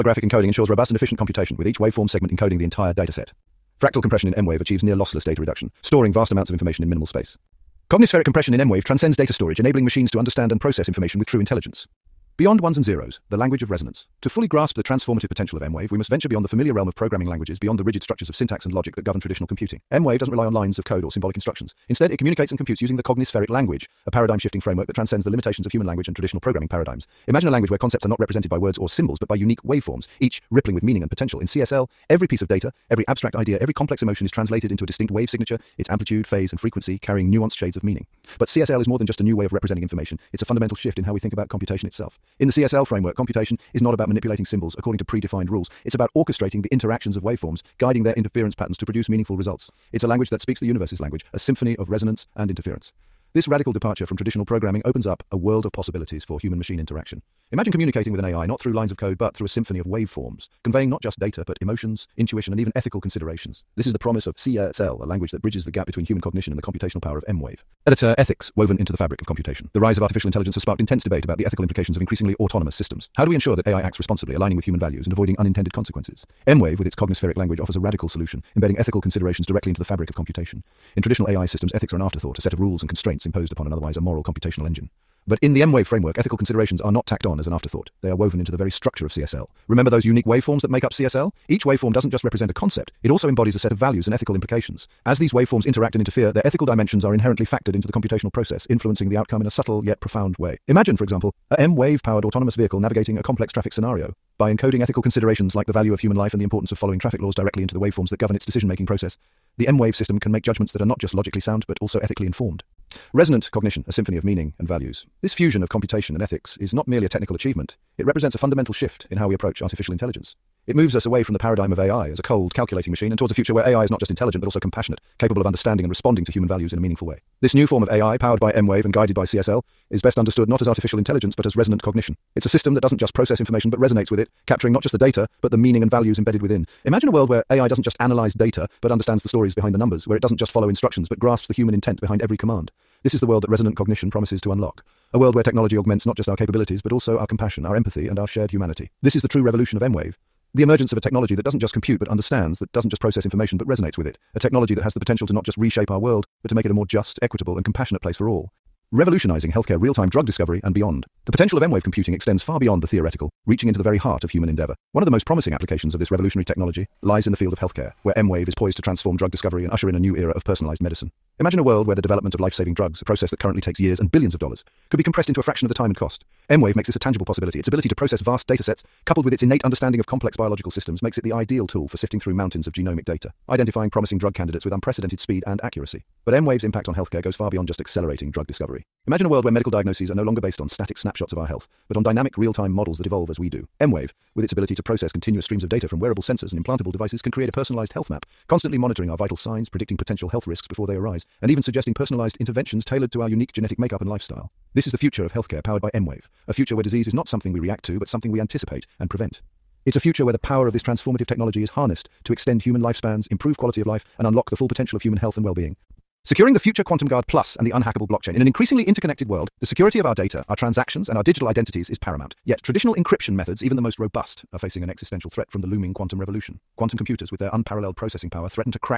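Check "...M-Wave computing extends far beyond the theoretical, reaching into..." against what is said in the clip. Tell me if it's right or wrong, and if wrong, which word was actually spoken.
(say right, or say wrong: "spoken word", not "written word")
right.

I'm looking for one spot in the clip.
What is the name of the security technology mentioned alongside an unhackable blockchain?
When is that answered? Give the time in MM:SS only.
03:36.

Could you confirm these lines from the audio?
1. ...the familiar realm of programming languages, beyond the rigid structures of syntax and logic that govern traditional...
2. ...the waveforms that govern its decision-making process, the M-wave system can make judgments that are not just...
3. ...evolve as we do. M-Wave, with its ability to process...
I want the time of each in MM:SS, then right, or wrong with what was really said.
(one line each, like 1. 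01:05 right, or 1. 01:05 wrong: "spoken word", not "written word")
1. 00:16 right
2. 01:47 right
3. 03:13 right.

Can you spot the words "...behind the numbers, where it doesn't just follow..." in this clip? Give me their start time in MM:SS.
02:19.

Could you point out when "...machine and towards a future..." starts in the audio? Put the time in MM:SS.
02:02.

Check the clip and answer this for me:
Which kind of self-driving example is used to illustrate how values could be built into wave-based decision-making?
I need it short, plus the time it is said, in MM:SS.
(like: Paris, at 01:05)
autonomous vehicle, at 01:42.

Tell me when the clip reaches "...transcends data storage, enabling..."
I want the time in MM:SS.
00:08.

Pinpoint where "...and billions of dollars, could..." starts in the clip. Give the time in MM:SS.
02:53.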